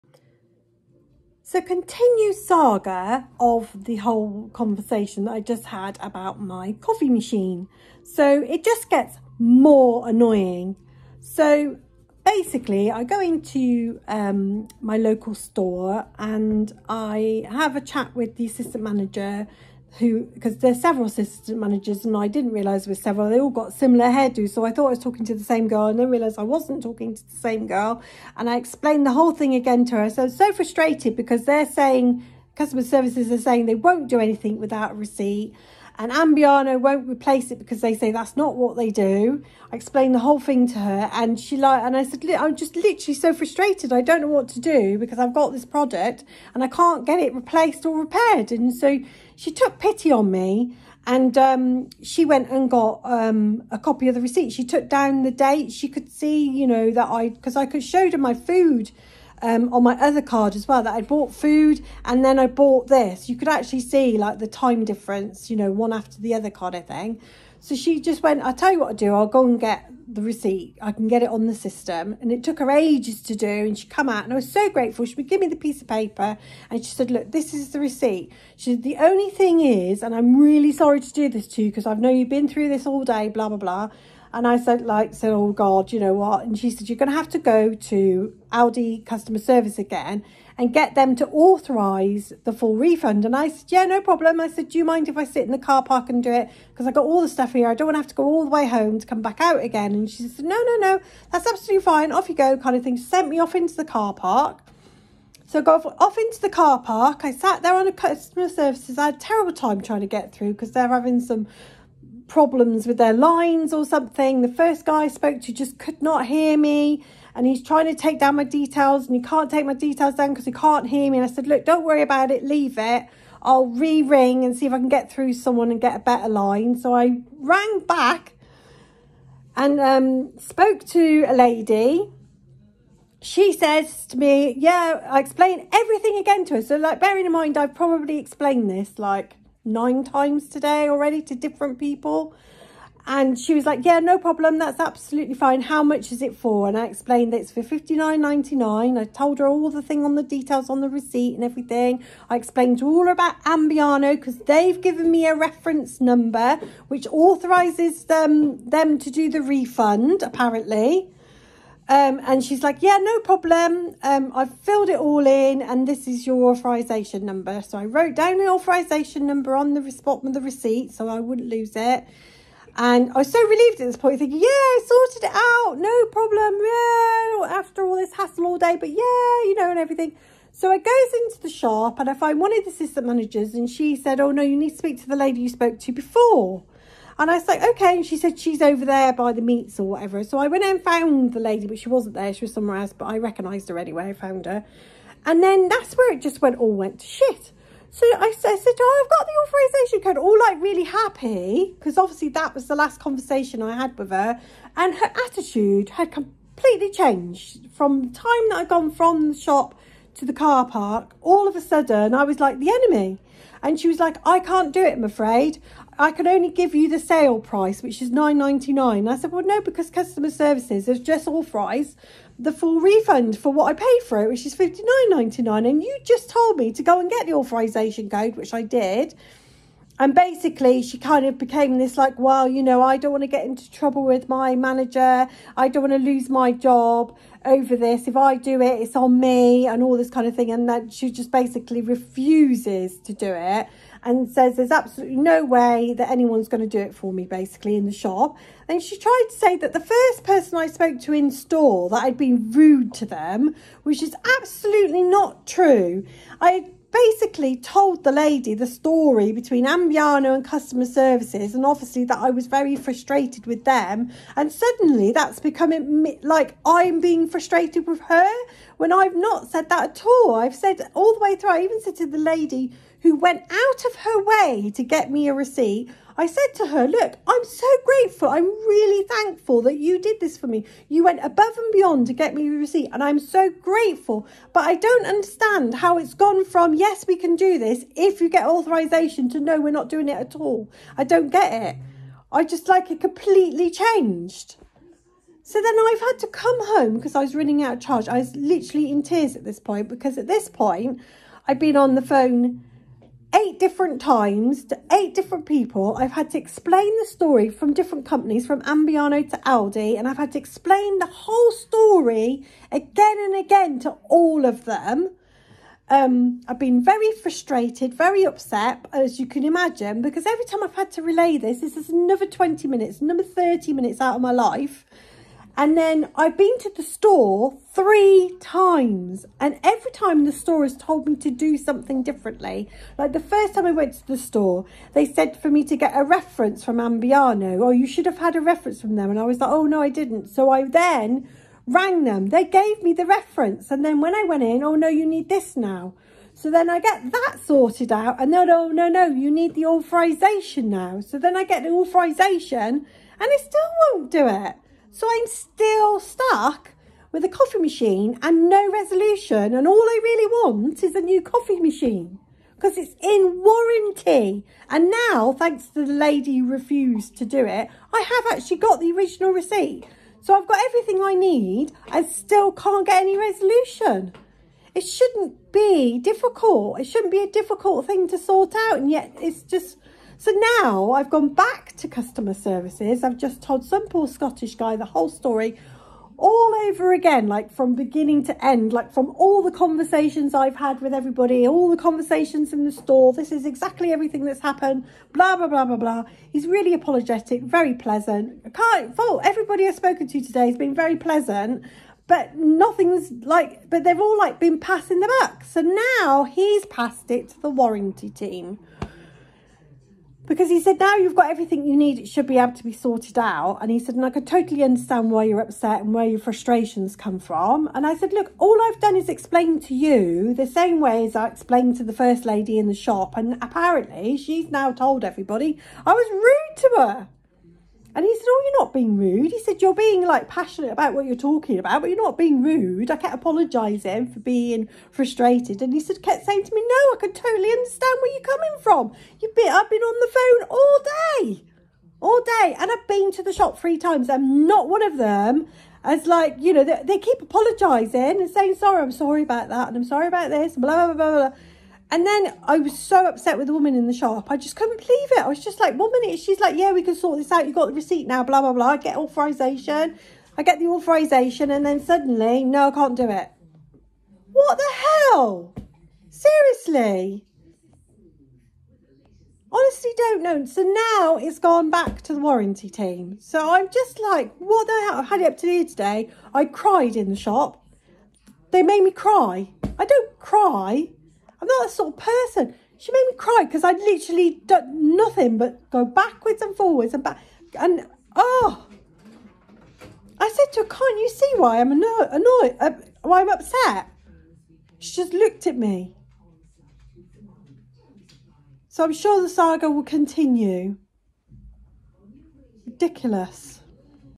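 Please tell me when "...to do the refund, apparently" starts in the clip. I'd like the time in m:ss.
2:38.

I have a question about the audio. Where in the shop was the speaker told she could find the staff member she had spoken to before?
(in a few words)
by the meats.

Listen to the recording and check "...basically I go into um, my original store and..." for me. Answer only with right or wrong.
wrong.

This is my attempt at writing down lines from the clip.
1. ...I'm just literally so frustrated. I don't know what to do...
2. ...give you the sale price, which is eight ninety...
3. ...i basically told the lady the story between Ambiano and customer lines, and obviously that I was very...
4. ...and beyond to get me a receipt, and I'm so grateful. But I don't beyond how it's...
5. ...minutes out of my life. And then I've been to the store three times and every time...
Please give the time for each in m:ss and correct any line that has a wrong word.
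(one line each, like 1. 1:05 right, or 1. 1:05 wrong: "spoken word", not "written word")
1. 0:42 right
2. 3:36 wrong: "nine", not "eight"
3. 4:16 wrong: "services", not "lines"
4. 4:41 wrong: "understand", not "beyond"
5. 5:23 right.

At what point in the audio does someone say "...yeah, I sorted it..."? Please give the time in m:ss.
2:54.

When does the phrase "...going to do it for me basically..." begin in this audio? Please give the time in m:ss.
4:06.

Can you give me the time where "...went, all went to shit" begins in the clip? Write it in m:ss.
3:16.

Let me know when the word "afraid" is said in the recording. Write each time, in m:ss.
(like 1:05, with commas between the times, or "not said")
3:35.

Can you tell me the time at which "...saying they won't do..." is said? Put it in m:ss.
0:33.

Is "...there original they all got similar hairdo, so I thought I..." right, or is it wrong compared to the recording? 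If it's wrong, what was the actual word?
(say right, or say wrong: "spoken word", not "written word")
wrong: "several", not "original".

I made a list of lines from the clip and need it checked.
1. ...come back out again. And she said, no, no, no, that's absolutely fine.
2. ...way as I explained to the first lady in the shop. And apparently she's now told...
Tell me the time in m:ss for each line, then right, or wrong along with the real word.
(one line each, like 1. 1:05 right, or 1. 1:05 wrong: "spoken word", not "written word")
1. 1:39 right
2. 7:00 right.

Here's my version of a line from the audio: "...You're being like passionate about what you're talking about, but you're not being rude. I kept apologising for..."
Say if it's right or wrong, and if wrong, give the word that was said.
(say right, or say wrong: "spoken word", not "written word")
right.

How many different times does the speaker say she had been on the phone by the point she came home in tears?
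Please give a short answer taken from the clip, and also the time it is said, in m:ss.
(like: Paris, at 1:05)
8, at 5:03.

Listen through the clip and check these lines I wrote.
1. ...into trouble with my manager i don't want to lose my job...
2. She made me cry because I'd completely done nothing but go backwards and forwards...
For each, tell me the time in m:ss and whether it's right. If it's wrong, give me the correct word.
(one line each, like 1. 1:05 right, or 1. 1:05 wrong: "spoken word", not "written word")
1. 3:53 right
2. 8:02 wrong: "literally", not "completely".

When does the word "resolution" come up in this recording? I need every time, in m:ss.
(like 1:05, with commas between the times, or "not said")
5:58, 6:13.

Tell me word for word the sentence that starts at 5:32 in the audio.
Like the first time I went to the store, they said for me to get a reference from Ambiano.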